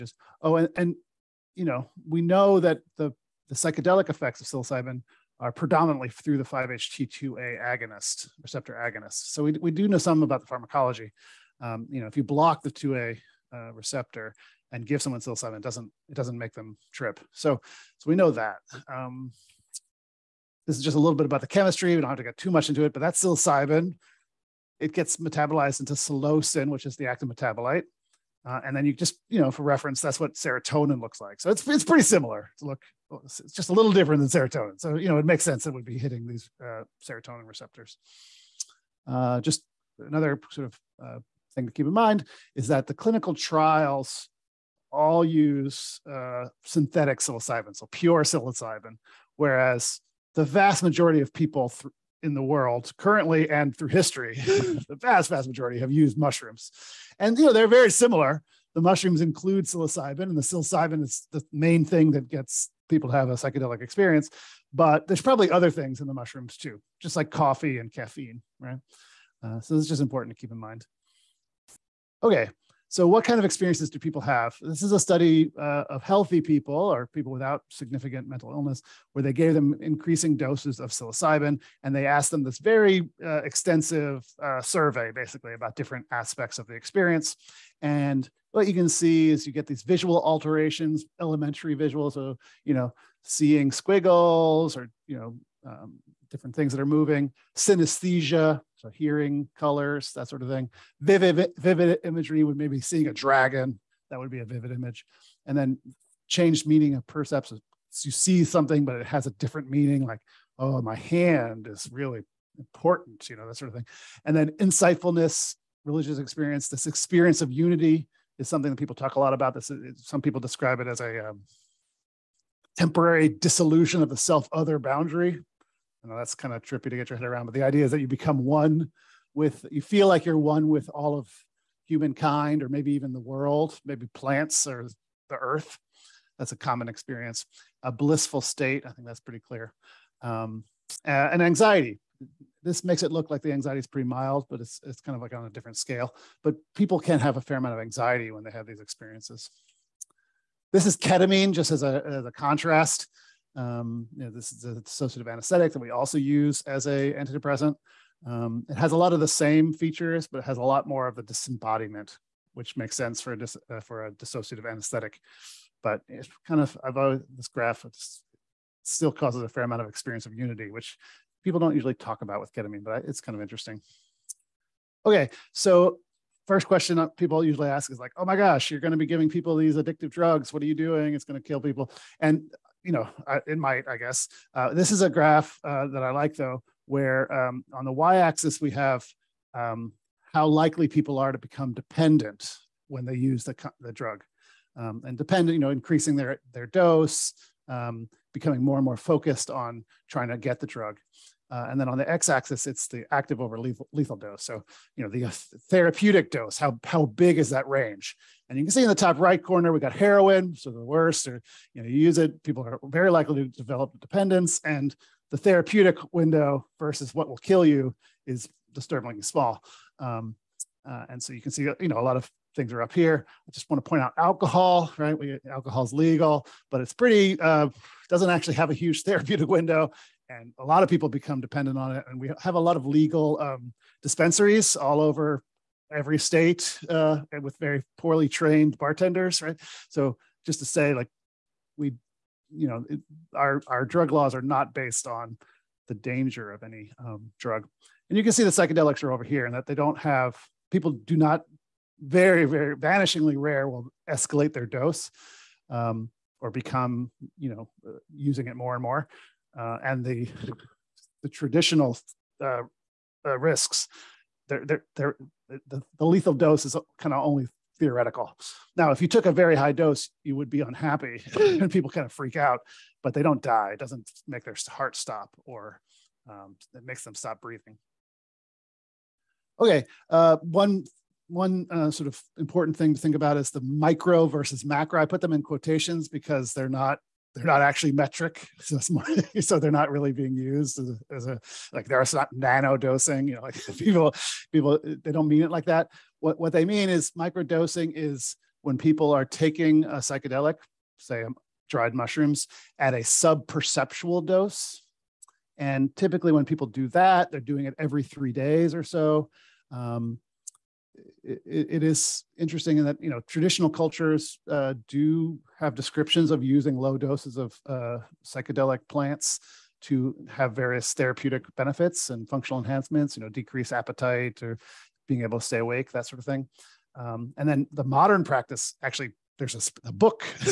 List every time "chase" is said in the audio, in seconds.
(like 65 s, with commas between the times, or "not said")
not said.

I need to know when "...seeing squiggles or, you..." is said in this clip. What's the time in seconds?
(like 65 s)
93 s.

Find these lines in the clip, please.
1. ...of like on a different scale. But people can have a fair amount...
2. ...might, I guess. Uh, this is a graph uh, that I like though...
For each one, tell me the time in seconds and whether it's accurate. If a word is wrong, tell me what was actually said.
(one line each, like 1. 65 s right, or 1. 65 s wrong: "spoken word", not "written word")
1. 145 s right
2. 183 s right.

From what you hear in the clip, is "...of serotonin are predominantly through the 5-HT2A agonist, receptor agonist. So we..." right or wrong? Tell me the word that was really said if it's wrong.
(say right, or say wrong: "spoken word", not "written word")
wrong: "psilocybin", not "serotonin".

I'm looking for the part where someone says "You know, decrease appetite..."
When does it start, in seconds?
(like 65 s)
323 s.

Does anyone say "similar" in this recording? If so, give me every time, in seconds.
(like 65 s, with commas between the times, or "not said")
32 s, 57 s.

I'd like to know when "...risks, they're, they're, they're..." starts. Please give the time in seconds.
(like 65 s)
263 s.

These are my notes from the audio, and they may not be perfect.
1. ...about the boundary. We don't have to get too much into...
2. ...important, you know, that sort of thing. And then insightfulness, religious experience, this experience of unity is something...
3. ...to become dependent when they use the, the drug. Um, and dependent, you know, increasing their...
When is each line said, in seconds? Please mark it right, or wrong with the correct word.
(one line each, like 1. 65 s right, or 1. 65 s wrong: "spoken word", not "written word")
1. 21 s wrong: "chemistry", not "boundary"
2. 112 s right
3. 191 s right.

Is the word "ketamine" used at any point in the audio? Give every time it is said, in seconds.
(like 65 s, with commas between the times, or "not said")
150 s, 172 s.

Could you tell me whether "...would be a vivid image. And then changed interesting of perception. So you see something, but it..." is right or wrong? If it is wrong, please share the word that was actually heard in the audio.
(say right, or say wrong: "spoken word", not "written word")
wrong: "meaning", not "interesting".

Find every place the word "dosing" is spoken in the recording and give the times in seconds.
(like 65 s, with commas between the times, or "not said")
292 s, 297 s.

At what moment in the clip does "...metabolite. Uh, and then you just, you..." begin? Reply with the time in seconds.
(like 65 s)
27 s.